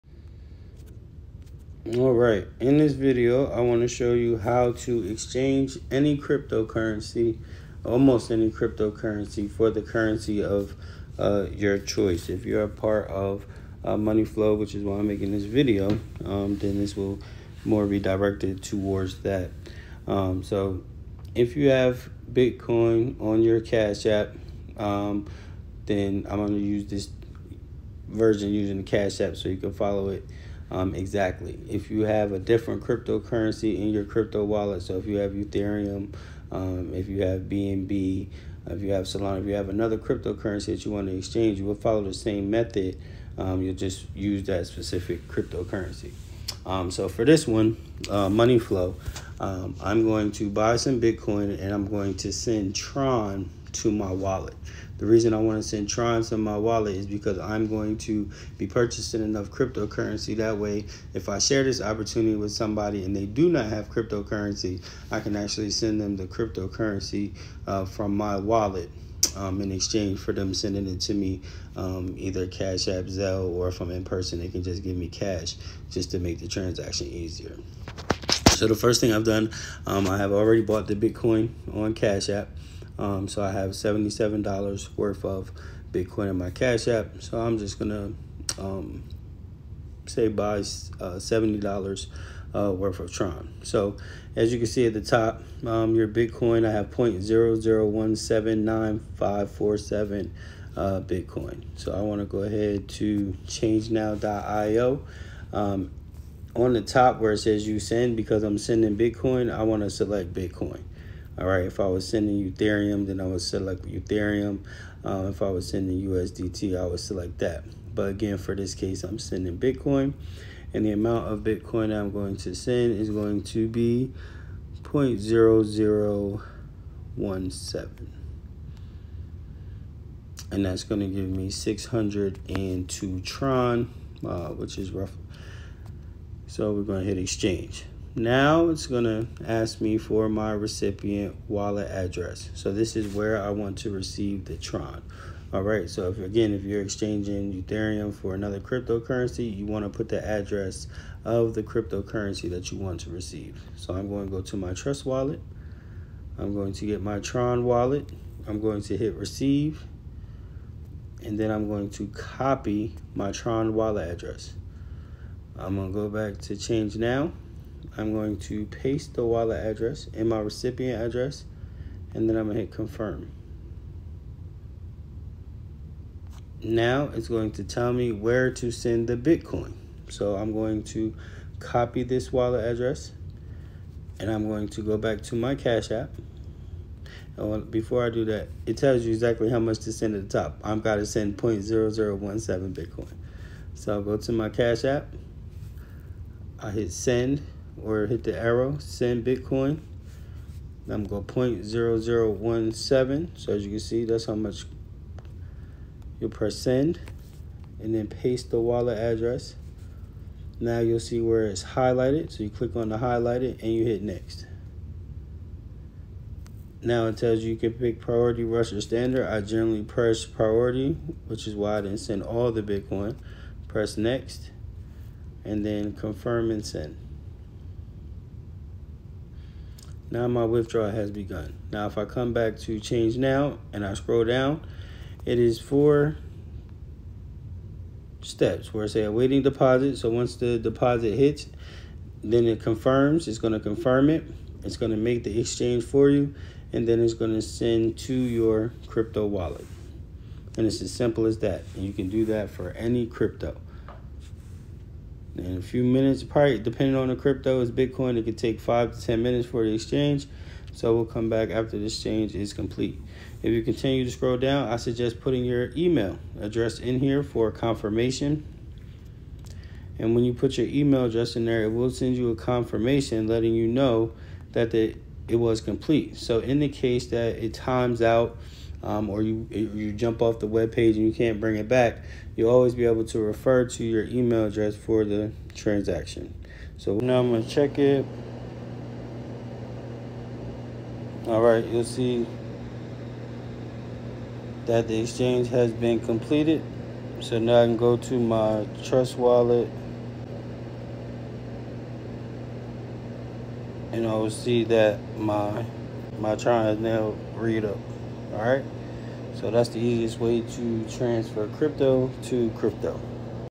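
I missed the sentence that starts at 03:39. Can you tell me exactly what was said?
I generally press priority, which is why I didn't send all the Bitcoin.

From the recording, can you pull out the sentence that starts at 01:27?
So I'm just going to um, say buy uh, $70 uh, worth of Tron.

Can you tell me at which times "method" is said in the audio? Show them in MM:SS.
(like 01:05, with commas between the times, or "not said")
00:42.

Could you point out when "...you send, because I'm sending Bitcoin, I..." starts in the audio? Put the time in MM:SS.
01:47.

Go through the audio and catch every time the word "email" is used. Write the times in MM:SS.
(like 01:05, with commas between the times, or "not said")
04:25, 04:30, 04:44.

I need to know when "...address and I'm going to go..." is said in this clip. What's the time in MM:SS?
03:02.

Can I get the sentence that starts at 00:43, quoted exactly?
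Um, you'll just use that specific cryptocurrency.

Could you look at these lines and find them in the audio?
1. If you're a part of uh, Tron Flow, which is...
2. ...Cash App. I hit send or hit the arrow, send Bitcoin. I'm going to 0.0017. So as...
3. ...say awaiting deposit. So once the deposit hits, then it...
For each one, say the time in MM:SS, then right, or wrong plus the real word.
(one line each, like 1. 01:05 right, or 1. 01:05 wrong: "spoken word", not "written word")
1. 00:12 wrong: "Money", not "Tron"
2. 03:14 right
3. 03:58 right.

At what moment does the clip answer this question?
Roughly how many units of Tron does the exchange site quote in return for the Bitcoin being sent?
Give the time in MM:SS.
02:11.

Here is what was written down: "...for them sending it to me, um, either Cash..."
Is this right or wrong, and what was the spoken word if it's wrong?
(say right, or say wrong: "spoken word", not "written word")
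right.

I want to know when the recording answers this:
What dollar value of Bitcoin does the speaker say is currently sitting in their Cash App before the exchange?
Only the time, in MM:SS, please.
01:23.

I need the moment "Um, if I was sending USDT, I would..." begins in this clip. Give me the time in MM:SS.
01:55.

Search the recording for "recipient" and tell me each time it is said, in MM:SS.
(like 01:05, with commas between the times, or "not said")
02:20, 02:50.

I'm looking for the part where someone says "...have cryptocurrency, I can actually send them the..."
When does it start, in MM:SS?
01:03.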